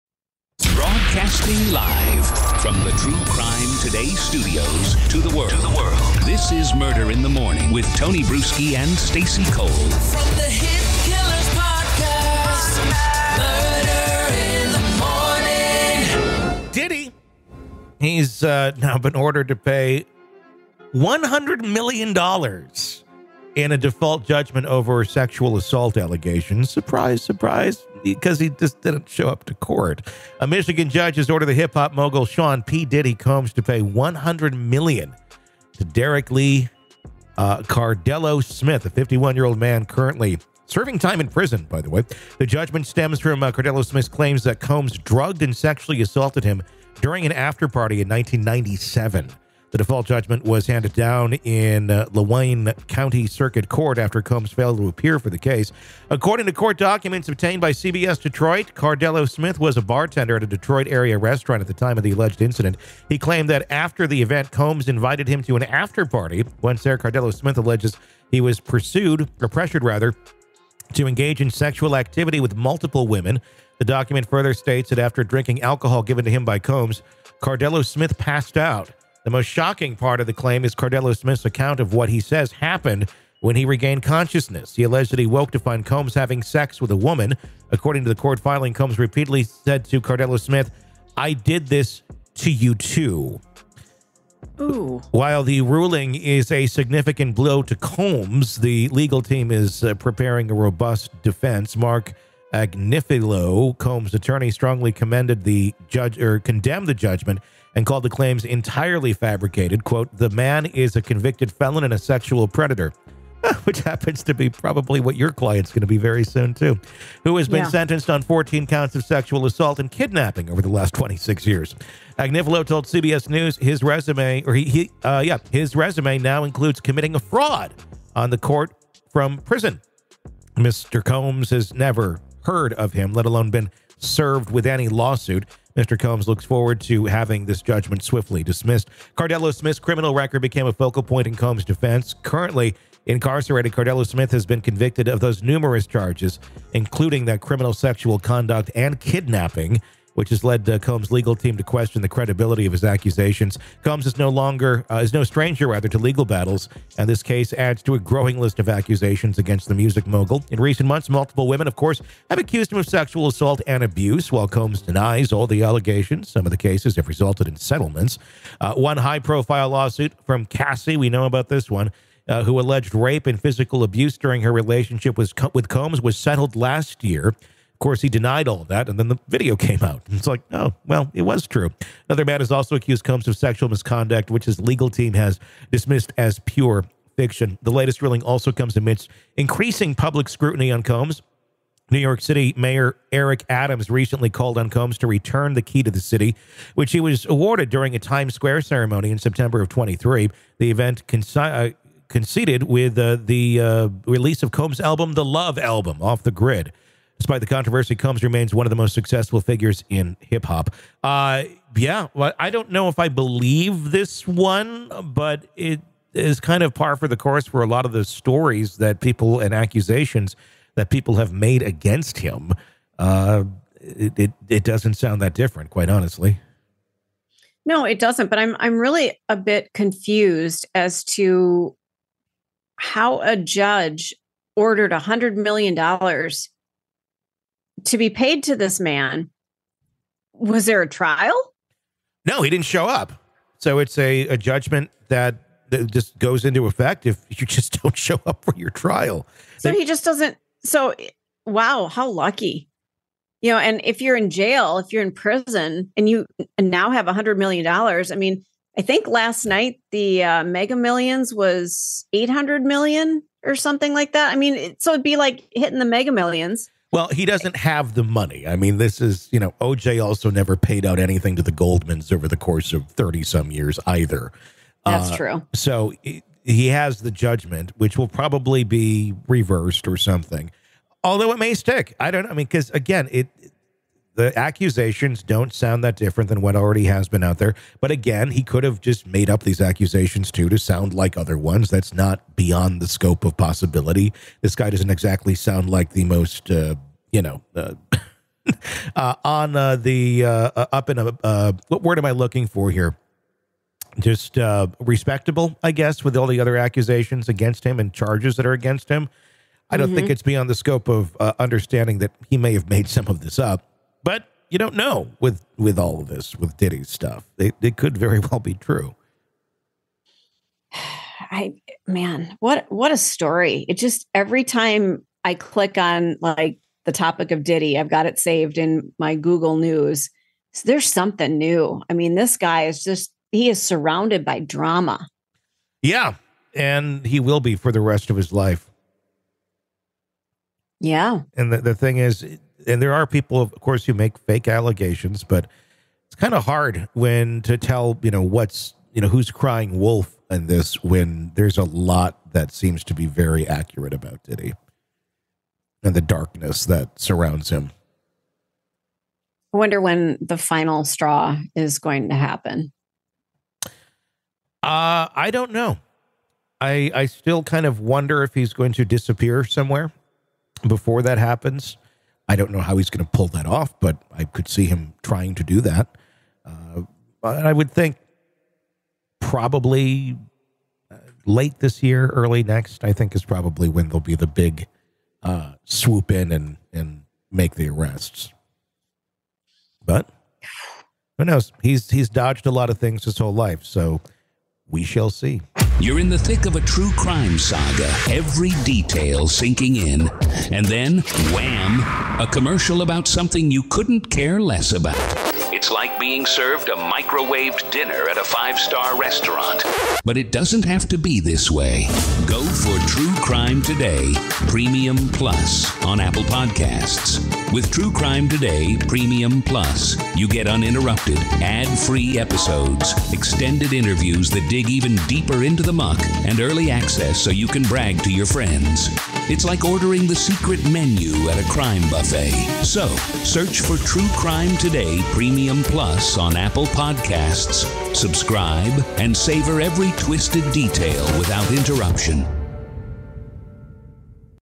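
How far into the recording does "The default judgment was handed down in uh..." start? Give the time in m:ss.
0:49.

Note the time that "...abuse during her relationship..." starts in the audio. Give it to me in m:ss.
2:53.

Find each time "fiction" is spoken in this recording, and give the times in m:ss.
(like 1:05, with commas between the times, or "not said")
3:07.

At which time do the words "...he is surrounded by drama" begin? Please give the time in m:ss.
5:33.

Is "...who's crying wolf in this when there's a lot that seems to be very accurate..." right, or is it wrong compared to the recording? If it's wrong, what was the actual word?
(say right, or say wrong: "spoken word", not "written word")
right.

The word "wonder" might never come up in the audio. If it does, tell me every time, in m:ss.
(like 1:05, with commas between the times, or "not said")
5:59, 6:07.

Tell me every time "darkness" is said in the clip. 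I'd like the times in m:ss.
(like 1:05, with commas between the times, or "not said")
5:56.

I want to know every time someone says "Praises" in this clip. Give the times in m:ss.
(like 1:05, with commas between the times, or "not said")
not said.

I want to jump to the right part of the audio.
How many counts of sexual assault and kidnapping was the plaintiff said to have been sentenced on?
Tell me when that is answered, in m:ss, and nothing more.
1:58.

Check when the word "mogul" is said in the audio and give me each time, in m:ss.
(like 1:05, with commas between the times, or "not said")
0:31, 2:40.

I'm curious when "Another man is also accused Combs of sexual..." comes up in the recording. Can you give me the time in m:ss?
3:02.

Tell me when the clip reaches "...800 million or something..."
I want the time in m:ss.
4:22.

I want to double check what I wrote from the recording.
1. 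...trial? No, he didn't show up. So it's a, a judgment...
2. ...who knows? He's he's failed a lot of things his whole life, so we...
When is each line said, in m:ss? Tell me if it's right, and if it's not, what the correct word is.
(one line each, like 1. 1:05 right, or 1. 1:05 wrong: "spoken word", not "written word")
1. 4:00 right
2. 6:31 wrong: "dodged", not "failed".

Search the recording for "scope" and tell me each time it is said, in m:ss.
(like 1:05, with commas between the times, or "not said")
4:52, 5:10.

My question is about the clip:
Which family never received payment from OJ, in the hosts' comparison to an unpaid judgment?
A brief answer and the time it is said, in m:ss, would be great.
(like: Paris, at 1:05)
The Goldmans, at 4:31.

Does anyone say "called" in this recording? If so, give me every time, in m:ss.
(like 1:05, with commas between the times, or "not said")
1:47, 3:14.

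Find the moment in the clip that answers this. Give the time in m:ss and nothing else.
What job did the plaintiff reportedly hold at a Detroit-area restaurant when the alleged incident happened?
0:59.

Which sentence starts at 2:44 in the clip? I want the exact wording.
While Combs denies all the allegations, some of the cases have resulted in settlements.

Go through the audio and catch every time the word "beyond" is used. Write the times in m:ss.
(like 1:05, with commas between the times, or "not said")
4:52, 5:10.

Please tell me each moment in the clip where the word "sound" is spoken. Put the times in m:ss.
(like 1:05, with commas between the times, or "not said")
3:44, 4:45, 4:50, 4:55.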